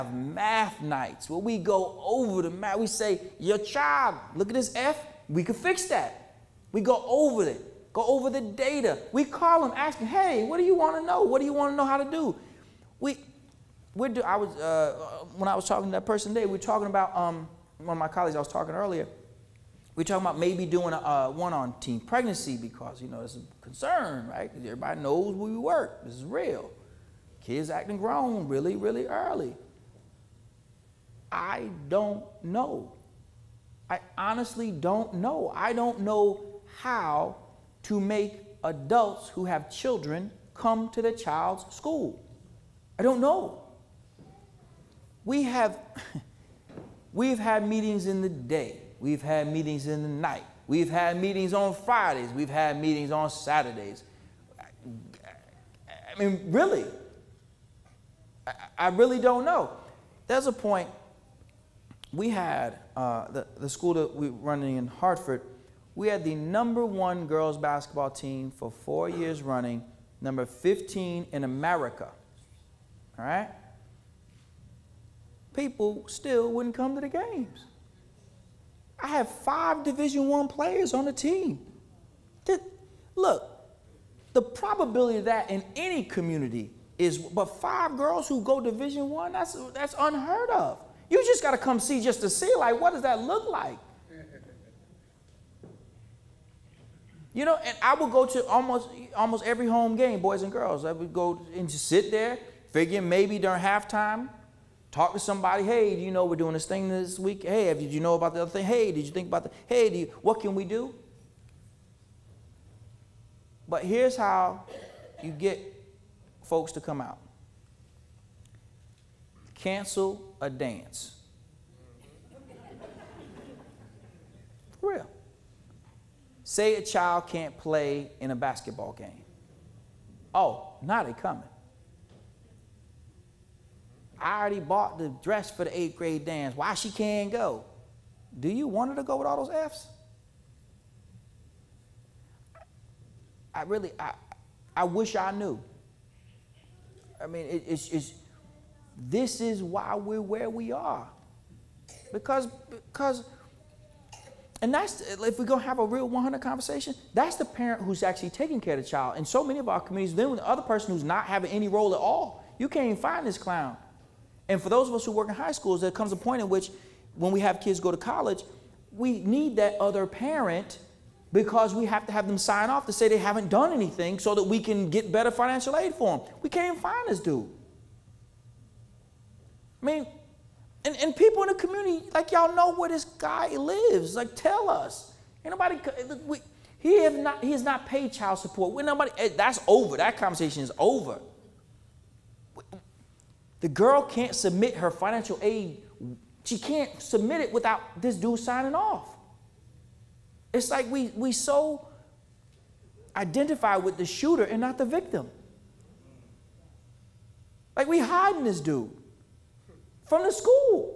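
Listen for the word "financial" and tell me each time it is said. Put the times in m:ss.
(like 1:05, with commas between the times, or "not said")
2:55, 3:14.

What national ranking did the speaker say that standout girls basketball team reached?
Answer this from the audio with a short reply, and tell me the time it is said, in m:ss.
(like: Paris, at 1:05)
15, at 1:10.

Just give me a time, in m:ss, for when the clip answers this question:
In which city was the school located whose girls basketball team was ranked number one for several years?
1:04.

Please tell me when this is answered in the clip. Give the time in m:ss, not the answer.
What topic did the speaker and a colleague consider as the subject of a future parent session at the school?
0:21.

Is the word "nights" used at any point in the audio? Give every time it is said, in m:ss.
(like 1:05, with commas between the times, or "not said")
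0:00, 0:50.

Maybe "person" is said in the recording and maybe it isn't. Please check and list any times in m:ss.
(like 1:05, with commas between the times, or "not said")
0:16, 2:40.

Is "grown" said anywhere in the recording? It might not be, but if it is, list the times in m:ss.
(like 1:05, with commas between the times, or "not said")
0:27.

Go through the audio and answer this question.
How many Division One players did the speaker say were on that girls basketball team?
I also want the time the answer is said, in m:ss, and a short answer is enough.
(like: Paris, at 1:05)
5, at 1:19.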